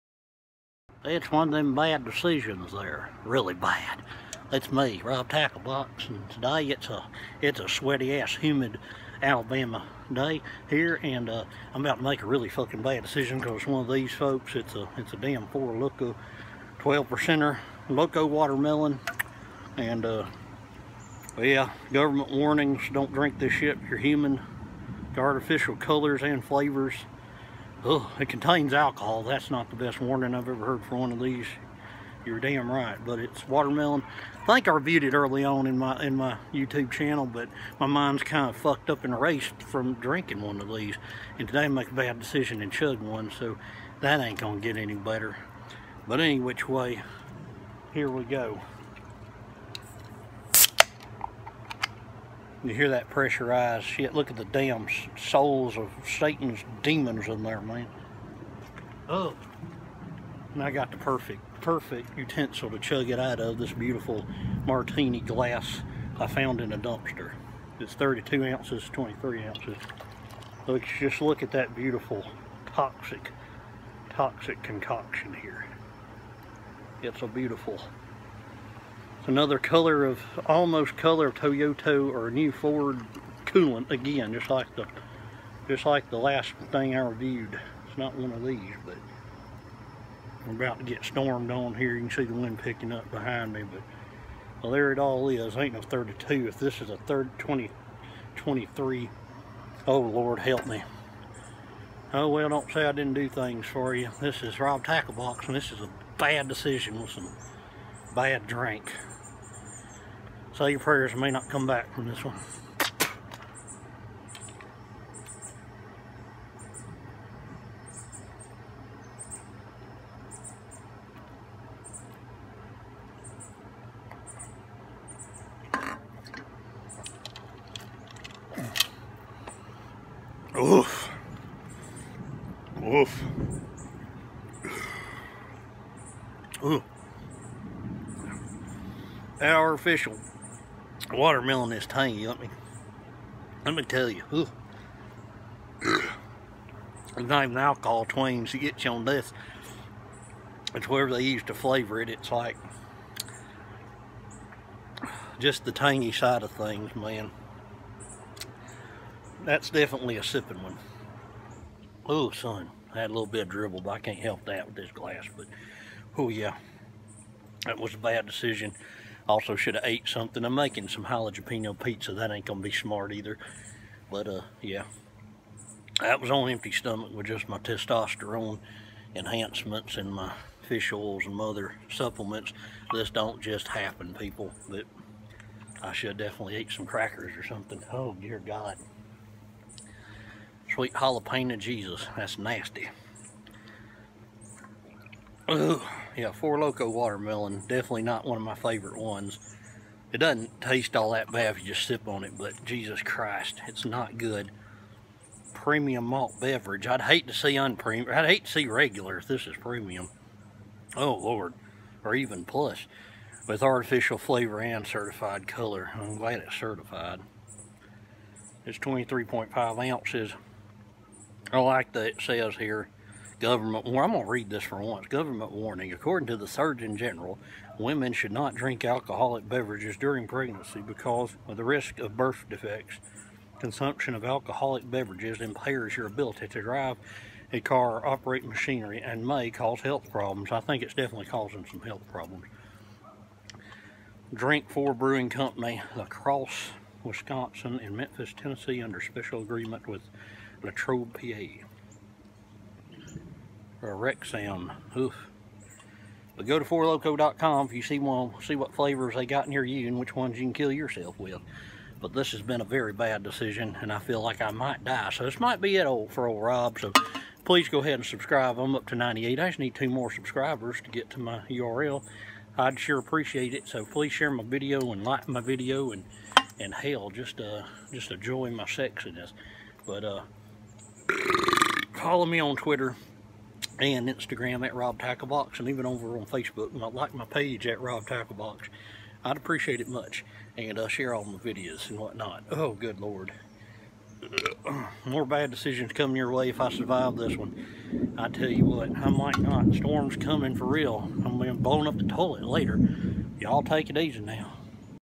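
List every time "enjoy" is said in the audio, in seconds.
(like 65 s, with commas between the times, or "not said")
278 s.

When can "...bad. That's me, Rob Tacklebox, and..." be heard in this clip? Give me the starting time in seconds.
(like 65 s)
3 s.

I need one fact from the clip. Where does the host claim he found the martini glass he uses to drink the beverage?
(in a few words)
in a dumpster.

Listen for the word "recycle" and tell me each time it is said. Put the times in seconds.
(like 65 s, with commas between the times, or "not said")
not said.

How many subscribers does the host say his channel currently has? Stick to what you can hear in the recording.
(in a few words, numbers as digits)
98.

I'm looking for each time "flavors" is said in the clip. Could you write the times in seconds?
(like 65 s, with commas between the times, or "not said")
26 s, 151 s, 214 s, 258 s.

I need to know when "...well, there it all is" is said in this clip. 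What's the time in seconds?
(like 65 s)
94 s.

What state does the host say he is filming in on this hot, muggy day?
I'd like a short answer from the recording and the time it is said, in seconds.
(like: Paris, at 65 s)
Alabama, at 9 s.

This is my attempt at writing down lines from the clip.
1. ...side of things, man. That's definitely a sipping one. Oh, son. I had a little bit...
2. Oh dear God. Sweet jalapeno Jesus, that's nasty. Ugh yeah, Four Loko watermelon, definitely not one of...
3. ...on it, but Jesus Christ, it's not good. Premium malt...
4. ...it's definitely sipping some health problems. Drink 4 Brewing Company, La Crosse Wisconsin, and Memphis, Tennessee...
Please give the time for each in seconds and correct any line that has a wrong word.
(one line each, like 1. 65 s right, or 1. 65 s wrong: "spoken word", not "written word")
1. 156 s right
2. 187 s right
3. 202 s right
4. 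240 s wrong: "causing", not "sipping".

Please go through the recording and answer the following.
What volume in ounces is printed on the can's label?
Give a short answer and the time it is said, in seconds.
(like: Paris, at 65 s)
23.5, at 218 s.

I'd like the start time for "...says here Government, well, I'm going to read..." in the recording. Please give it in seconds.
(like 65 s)
222 s.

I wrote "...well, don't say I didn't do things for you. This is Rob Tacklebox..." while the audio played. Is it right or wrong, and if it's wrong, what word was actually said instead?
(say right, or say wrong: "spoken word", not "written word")
right.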